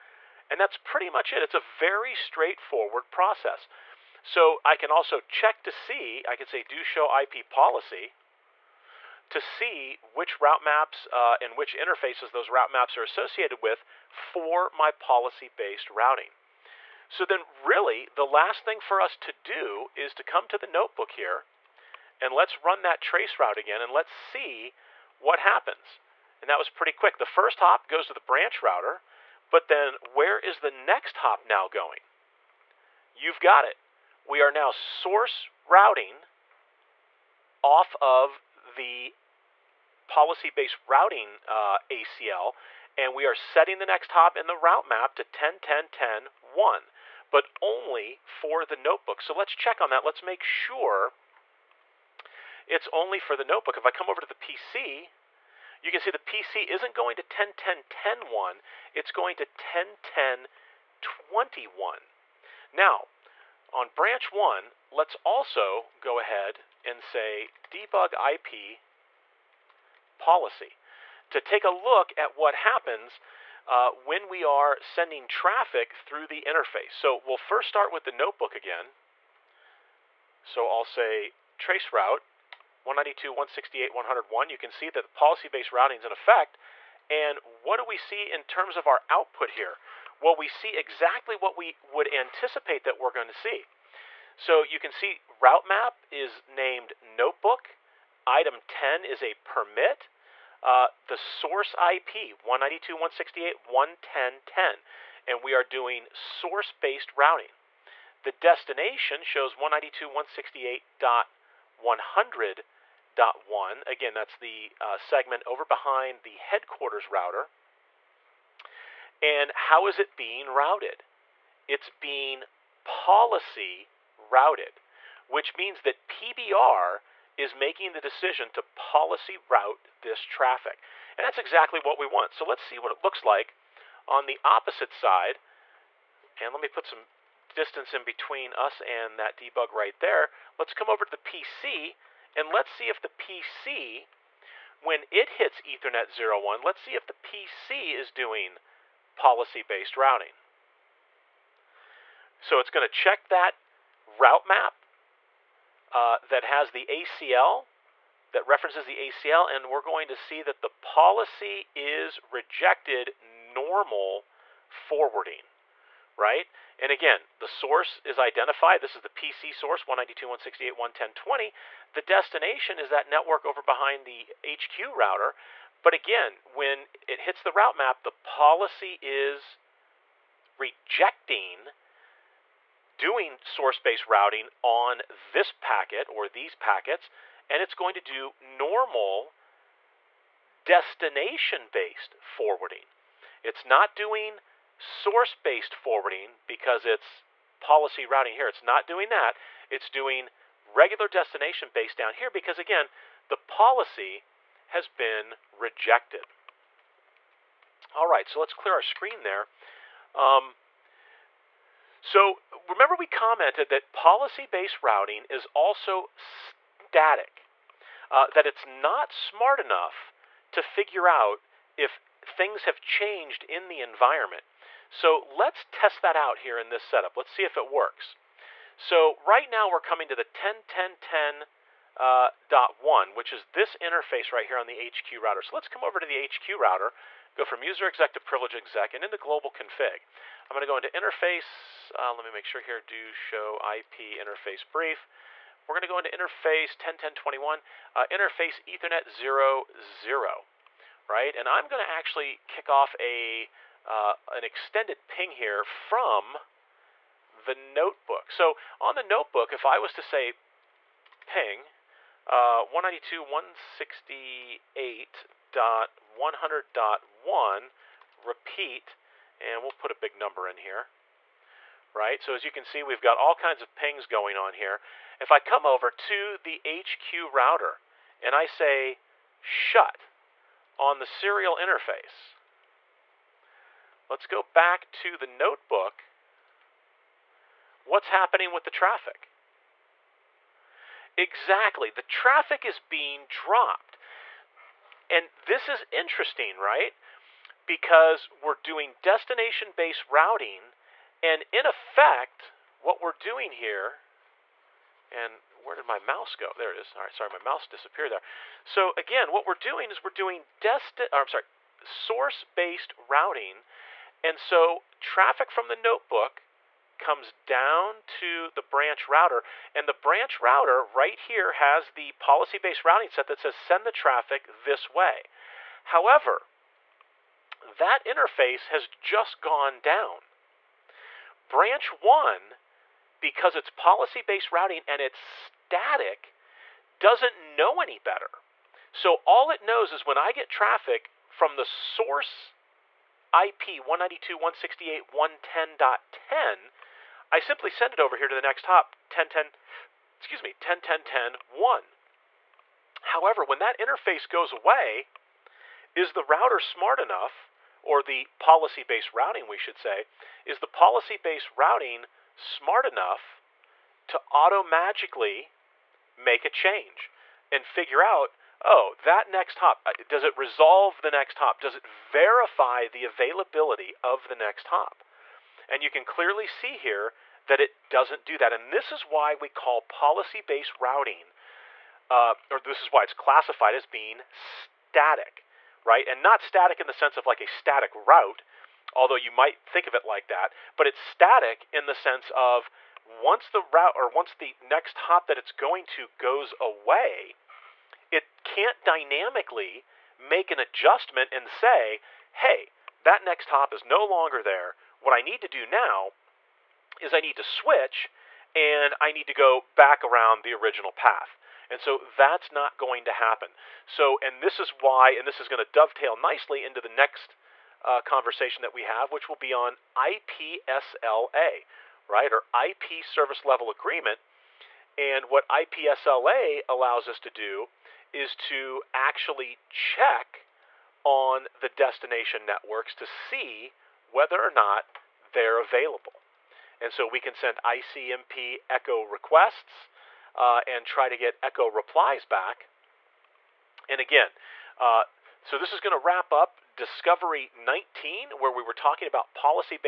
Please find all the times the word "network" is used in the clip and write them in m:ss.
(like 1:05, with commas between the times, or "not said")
2:53, 7:12.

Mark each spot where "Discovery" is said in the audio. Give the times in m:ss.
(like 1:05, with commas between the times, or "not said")
7:26.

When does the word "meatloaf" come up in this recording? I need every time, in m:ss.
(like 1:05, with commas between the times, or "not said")
not said.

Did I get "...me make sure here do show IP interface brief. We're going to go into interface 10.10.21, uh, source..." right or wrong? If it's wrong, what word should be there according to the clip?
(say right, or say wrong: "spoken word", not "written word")
wrong: "interface", not "source".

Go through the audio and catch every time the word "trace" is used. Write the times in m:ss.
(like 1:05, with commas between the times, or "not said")
0:23, 1:21.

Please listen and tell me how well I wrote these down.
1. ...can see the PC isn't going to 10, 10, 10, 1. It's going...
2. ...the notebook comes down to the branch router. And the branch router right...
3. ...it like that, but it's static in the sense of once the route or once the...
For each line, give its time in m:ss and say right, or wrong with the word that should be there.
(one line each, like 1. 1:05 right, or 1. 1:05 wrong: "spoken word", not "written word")
1. 0:55 right
2. 5:15 right
3. 6:29 right.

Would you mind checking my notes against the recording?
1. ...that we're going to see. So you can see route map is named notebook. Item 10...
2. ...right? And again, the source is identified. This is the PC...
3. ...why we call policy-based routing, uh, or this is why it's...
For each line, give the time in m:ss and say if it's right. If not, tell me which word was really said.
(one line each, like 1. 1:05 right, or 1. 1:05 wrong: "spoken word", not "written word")
1. 1:32 right
2. 2:46 right
3. 6:19 right.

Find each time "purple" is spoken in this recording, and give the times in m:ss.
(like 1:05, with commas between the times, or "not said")
not said.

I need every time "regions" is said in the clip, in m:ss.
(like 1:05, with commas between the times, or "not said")
not said.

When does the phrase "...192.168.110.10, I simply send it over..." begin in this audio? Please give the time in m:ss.
5:43.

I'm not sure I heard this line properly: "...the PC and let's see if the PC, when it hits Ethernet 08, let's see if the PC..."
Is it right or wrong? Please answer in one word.
wrong.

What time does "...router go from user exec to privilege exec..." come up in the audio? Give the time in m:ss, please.
3:56.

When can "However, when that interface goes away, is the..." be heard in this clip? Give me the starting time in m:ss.
5:53.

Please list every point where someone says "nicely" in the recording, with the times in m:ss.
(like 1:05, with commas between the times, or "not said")
6:56.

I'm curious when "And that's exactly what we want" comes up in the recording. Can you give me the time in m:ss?
2:11.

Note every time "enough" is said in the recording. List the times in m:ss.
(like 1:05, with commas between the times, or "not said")
3:39, 5:56, 6:02.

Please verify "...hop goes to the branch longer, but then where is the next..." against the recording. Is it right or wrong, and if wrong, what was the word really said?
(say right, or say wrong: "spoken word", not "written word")
wrong: "router", not "longer".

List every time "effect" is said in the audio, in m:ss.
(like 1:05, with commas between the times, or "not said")
1:26, 5:01.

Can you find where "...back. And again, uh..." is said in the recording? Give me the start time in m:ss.
7:22.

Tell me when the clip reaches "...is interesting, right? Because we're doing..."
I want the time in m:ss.
4:55.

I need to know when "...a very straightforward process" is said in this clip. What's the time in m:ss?
0:01.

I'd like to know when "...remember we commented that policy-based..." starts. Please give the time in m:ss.
3:32.